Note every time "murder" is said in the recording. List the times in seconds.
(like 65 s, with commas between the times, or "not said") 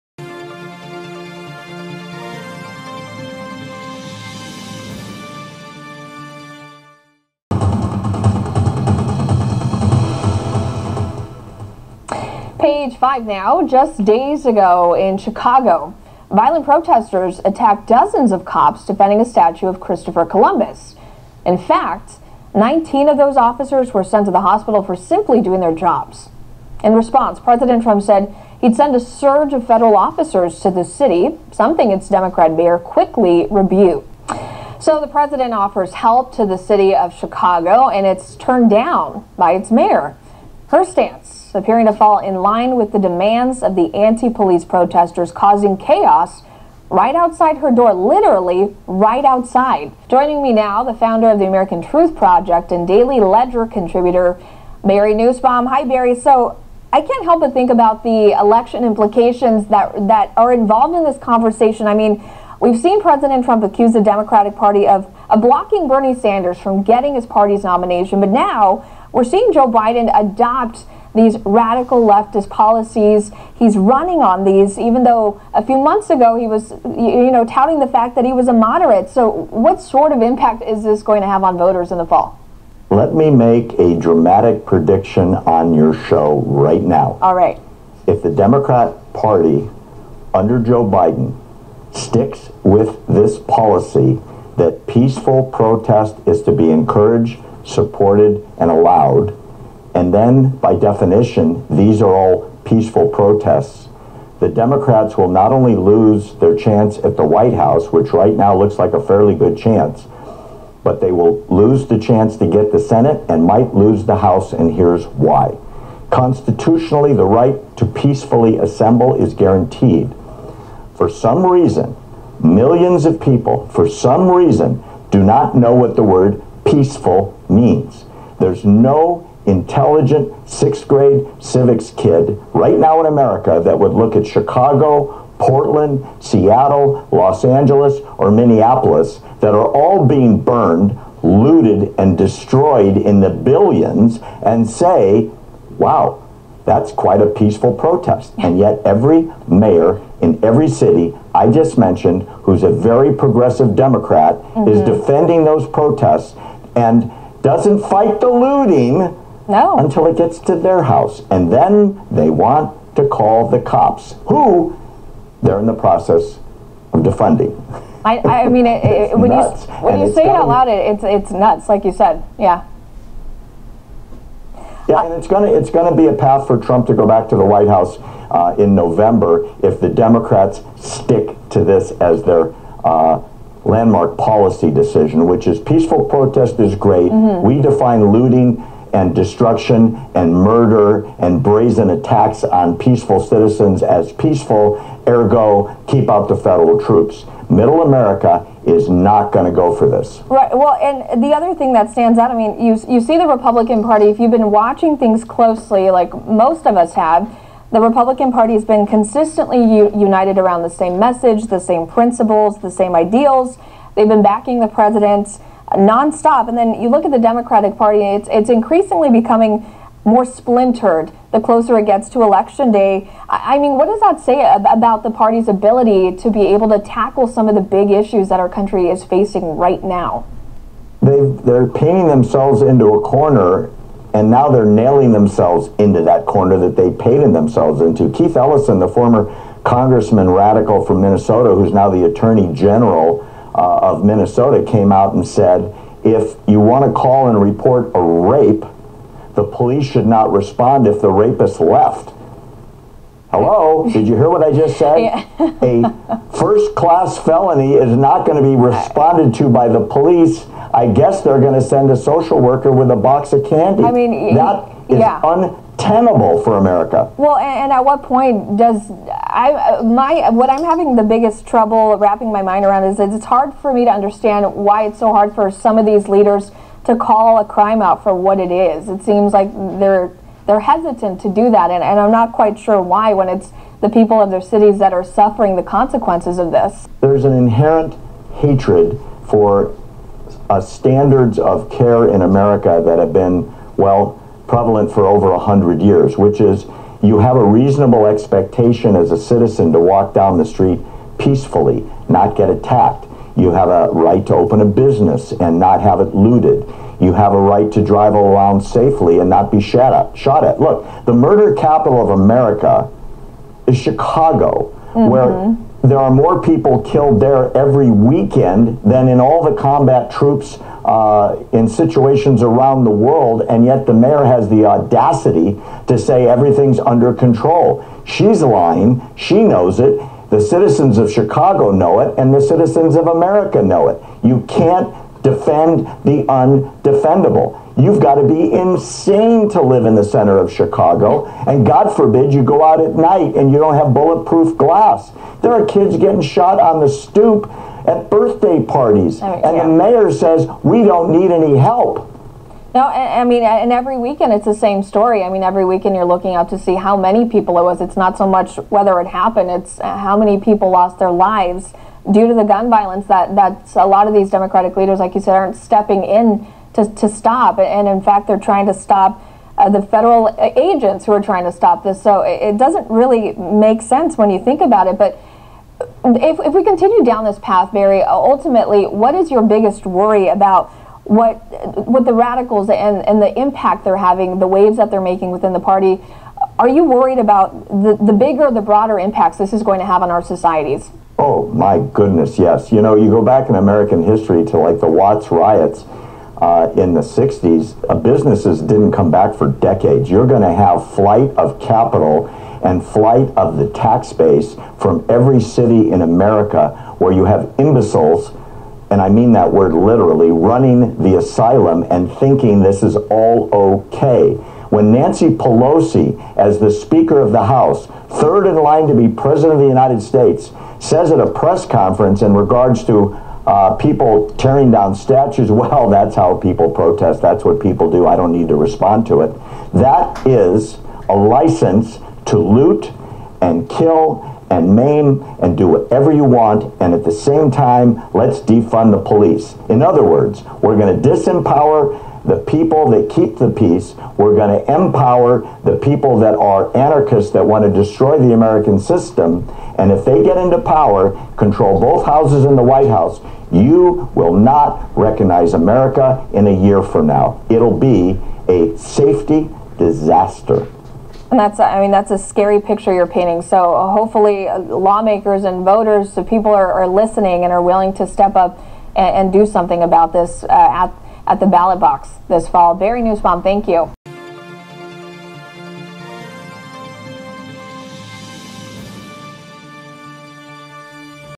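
190 s, 311 s.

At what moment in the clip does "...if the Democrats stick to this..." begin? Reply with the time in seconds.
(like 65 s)
179 s.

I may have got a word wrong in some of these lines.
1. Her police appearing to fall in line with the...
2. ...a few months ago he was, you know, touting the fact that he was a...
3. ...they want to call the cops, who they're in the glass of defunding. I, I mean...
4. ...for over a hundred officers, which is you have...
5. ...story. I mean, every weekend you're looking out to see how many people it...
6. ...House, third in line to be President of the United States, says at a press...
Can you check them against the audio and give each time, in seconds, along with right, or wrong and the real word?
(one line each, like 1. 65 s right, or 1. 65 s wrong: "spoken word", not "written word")
1. 40 s wrong: "stance", not "police"
2. 75 s right
3. 162 s wrong: "process", not "glass"
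4. 294 s wrong: "years", not "officers"
5. 354 s right
6. 417 s right.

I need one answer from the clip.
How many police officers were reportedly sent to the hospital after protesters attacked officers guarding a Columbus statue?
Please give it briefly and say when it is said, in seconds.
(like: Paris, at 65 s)
19, at 22 s.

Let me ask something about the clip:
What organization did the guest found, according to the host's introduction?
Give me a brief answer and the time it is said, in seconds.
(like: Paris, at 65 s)
American Truth Project, at 51 s.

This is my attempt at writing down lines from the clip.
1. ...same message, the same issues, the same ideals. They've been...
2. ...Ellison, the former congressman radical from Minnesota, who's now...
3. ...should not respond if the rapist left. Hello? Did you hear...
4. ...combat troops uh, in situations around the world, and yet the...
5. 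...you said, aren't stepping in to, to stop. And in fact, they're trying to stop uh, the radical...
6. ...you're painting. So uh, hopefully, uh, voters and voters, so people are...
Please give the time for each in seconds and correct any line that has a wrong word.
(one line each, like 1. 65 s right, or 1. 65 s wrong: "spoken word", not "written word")
1. 210 s wrong: "principles", not "issues"
2. 238 s right
3. 249 s right
4. 319 s right
5. 365 s wrong: "federal", not "radical"
6. 462 s wrong: "lawmakers", not "voters".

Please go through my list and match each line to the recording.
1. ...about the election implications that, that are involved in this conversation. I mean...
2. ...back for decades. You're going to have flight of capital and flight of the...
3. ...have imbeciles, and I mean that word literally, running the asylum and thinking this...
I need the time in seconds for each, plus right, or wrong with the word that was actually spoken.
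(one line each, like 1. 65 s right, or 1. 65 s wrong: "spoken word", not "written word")
1. 57 s right
2. 399 s right
3. 407 s right.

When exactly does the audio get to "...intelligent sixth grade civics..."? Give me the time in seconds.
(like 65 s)
129 s.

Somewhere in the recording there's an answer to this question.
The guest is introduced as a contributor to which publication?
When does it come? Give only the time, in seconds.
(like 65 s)
52 s.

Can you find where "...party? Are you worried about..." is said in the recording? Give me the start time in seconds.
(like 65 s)
385 s.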